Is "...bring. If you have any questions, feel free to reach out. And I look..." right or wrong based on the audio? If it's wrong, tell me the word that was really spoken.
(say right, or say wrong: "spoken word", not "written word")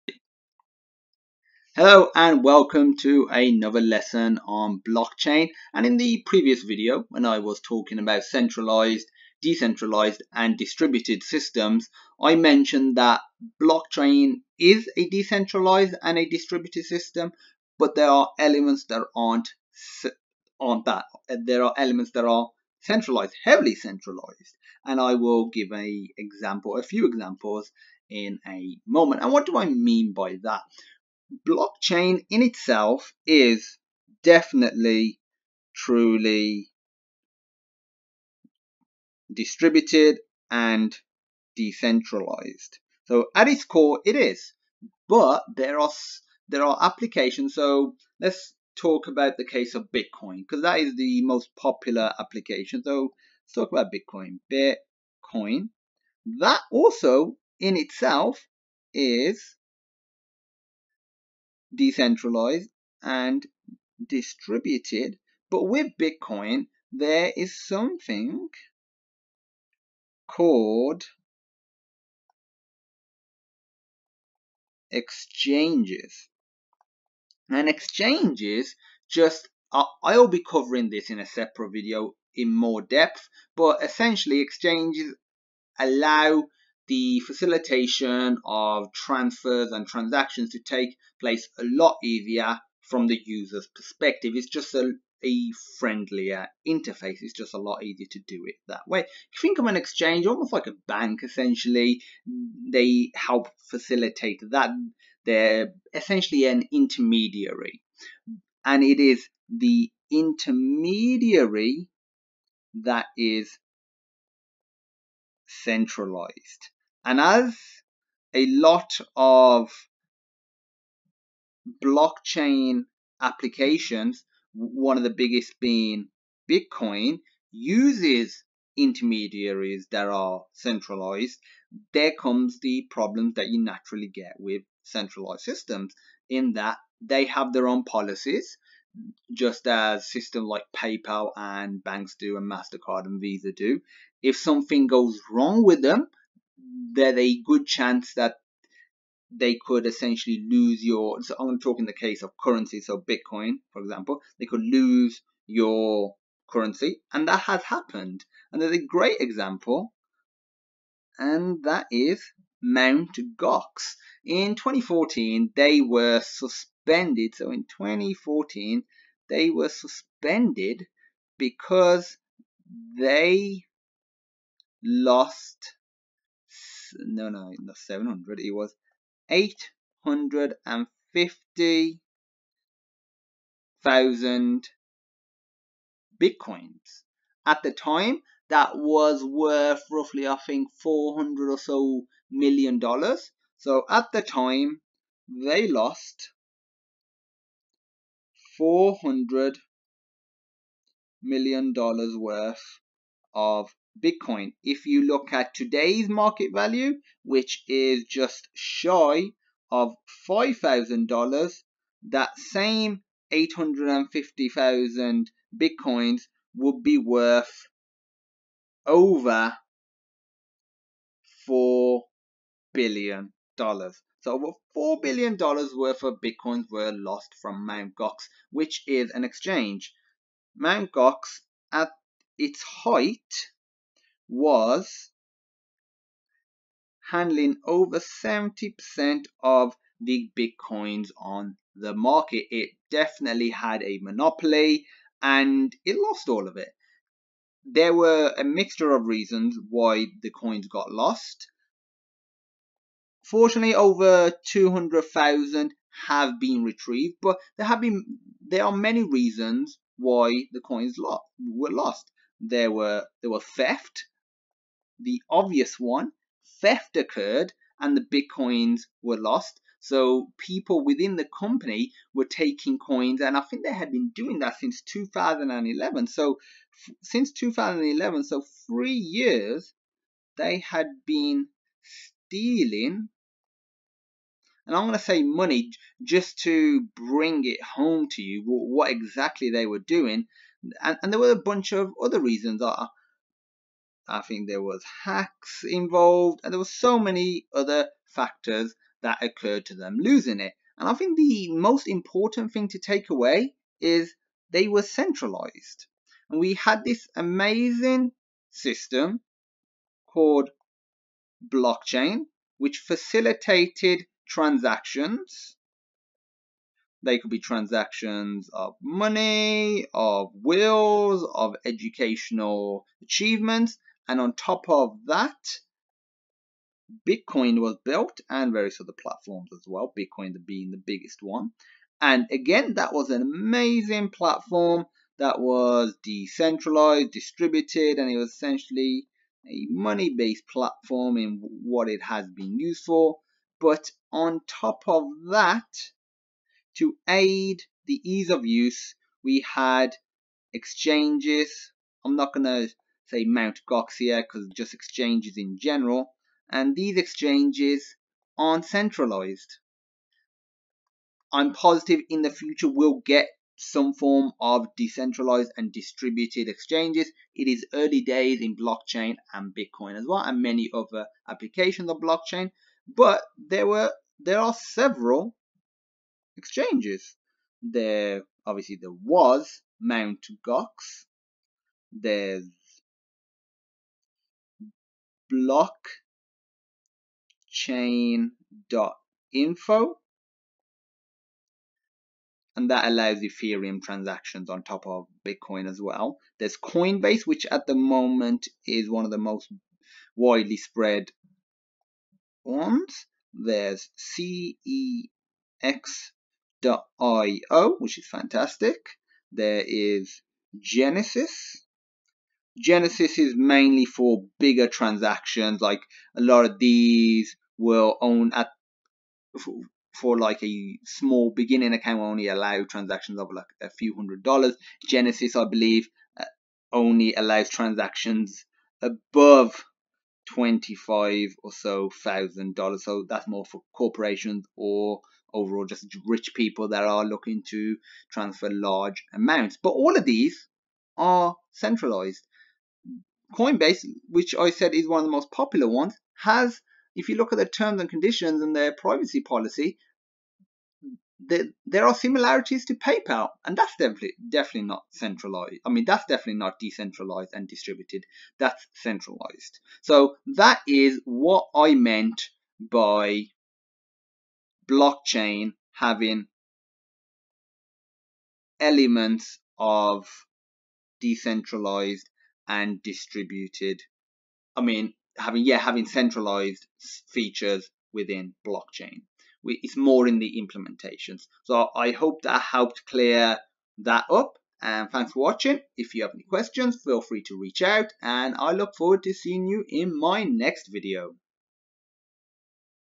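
wrong: "watching", not "bring".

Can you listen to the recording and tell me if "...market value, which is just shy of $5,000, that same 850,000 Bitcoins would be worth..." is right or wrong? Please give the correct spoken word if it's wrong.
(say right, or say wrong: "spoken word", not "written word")
right.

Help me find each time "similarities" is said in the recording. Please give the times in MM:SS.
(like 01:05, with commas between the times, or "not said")
07:31.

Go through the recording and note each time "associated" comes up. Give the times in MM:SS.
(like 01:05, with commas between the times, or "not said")
not said.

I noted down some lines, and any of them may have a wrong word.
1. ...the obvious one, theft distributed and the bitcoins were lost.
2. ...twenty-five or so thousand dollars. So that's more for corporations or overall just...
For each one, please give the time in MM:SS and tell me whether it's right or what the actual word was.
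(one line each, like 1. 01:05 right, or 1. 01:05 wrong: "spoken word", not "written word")
1. 04:25 wrong: "occurred", not "distributed"
2. 07:10 right.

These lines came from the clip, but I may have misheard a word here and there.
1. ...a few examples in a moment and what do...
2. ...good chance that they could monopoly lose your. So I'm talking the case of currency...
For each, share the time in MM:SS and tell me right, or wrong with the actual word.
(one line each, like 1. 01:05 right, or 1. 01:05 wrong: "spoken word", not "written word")
1. 00:26 right
2. 02:27 wrong: "essentially", not "monopoly".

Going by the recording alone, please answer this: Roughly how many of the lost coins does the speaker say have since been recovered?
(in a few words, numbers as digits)
over 200,000.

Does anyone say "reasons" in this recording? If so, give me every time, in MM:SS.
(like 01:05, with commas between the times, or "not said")
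04:09, 04:19, 04:52.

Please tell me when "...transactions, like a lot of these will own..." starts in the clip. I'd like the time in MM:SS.
06:54.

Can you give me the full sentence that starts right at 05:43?
But on top of that, to aid the ease of use, we had exchanges.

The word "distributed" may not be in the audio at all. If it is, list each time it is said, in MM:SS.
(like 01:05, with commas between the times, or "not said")
00:10, 00:16, 00:39, 01:04, 05:37, 06:05, 07:37, 07:52.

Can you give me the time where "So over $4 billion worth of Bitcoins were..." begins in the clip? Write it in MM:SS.
03:43.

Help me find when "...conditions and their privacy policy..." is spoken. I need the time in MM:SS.
07:27.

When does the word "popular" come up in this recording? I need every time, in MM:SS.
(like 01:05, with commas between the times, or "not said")
00:51, 07:25.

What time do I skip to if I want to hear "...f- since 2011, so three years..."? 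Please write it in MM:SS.
04:36.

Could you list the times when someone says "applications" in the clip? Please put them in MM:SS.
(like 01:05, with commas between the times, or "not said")
00:46, 00:52, 02:03, 06:11.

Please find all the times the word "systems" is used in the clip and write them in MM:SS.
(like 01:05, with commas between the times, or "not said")
00:11, 00:16, 02:15, 02:20, 05:08.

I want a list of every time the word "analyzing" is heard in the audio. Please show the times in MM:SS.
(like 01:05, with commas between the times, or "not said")
not said.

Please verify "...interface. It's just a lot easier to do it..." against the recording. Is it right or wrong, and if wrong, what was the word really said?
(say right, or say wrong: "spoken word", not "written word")
right.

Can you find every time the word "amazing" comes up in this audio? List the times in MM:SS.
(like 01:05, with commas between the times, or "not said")
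05:07, 05:33.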